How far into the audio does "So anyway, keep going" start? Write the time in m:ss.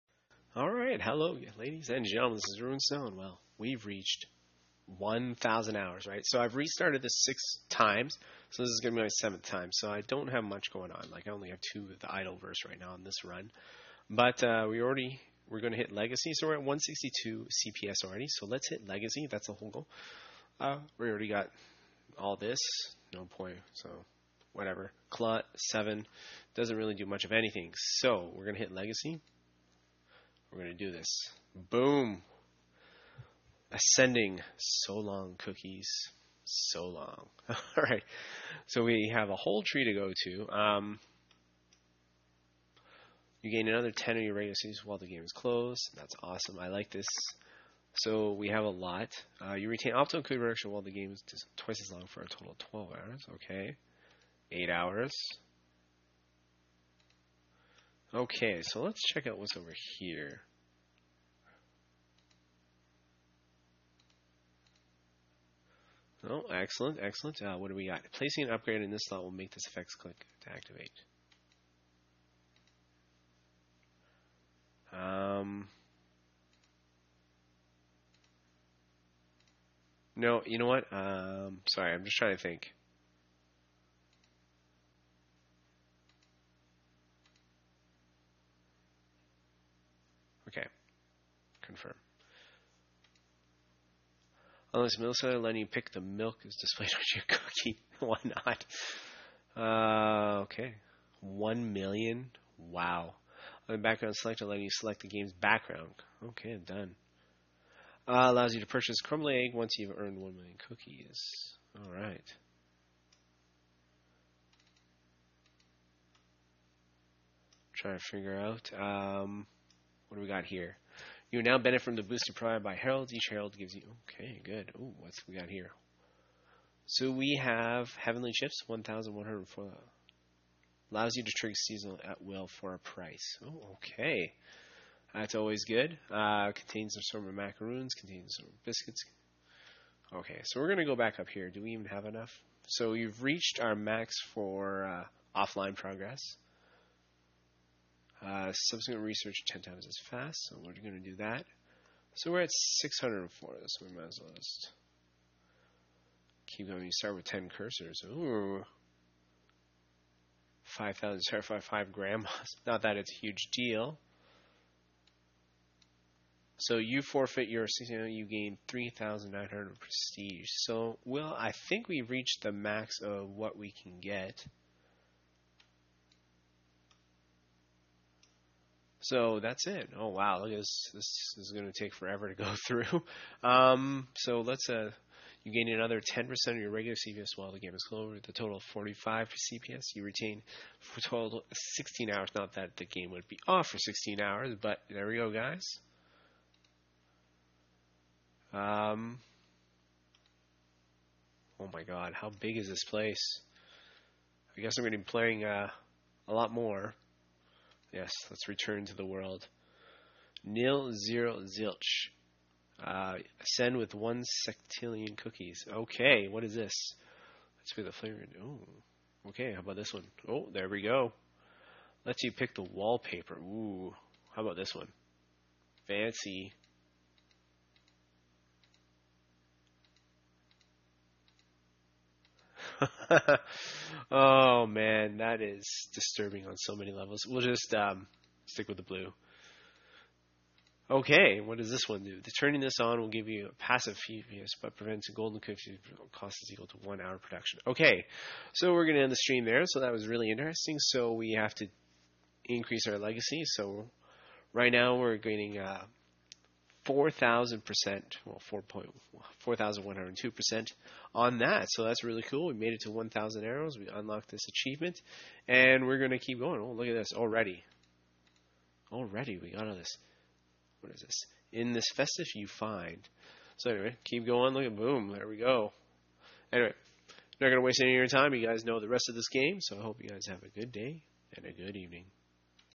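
4:33.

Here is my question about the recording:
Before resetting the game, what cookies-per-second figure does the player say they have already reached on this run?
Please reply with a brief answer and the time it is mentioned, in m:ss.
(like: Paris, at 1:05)
162, at 0:16.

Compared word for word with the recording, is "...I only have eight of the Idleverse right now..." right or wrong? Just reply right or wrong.
wrong.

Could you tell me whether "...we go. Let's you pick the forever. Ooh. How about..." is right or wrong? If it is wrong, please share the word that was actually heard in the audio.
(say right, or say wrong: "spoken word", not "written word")
wrong: "wallpaper", not "forever".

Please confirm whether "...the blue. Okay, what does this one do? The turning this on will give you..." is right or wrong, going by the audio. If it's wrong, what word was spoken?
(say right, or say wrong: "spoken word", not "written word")
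right.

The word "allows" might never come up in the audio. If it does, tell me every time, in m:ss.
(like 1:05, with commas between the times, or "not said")
1:48, 2:10.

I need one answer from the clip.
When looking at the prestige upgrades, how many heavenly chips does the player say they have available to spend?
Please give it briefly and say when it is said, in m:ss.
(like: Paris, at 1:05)
1,104, at 2:08.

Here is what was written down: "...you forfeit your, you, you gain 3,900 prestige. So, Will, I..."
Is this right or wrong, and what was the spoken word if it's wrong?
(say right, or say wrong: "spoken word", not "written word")
right.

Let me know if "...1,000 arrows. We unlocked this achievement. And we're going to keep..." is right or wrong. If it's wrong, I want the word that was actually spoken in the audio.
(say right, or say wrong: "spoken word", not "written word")
right.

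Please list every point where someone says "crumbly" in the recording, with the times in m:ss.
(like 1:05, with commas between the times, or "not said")
1:49.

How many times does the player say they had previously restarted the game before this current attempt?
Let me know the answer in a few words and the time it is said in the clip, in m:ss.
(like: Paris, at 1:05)
6, at 0:07.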